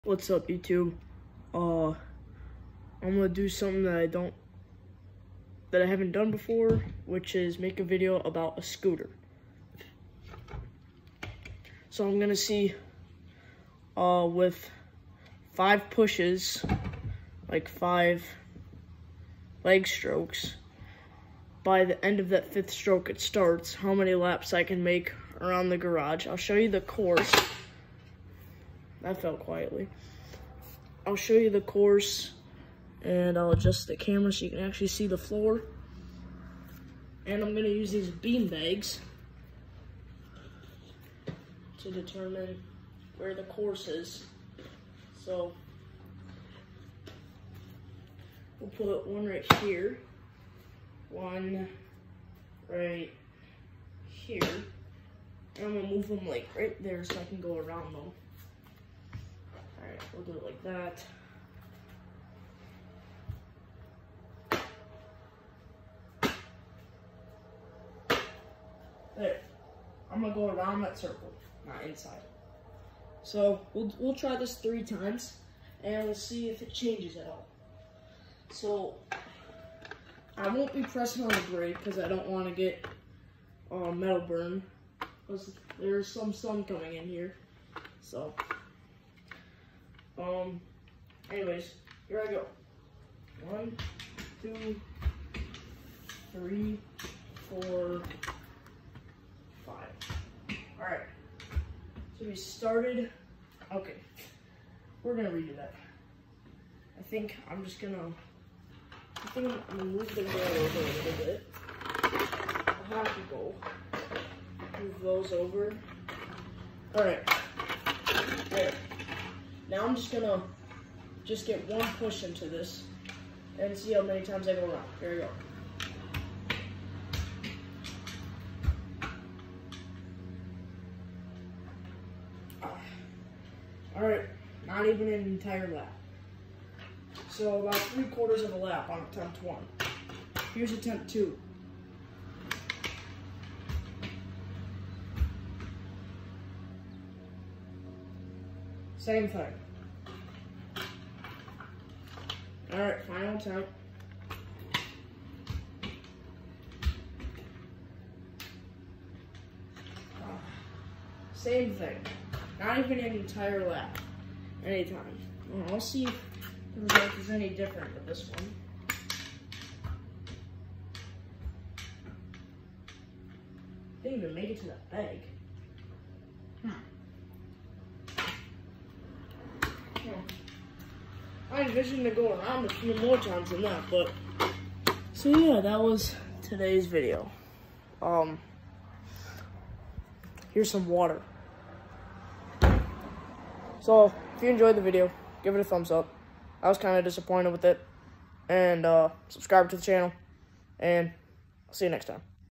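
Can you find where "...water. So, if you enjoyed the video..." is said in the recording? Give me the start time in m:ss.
3:10.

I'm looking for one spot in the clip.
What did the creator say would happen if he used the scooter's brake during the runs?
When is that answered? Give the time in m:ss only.
1:23.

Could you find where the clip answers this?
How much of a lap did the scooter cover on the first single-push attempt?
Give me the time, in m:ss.
2:17.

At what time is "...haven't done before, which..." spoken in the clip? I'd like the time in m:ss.
0:05.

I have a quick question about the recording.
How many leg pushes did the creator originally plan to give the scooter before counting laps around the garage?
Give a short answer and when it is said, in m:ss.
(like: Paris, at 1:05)
5, at 0:15.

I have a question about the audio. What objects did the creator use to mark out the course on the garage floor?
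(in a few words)
bean bags.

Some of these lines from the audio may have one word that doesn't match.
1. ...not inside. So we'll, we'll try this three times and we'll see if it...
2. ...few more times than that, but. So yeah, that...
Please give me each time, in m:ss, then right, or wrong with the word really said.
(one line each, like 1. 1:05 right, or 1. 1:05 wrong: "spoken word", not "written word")
1. 1:11 right
2. 3:02 right.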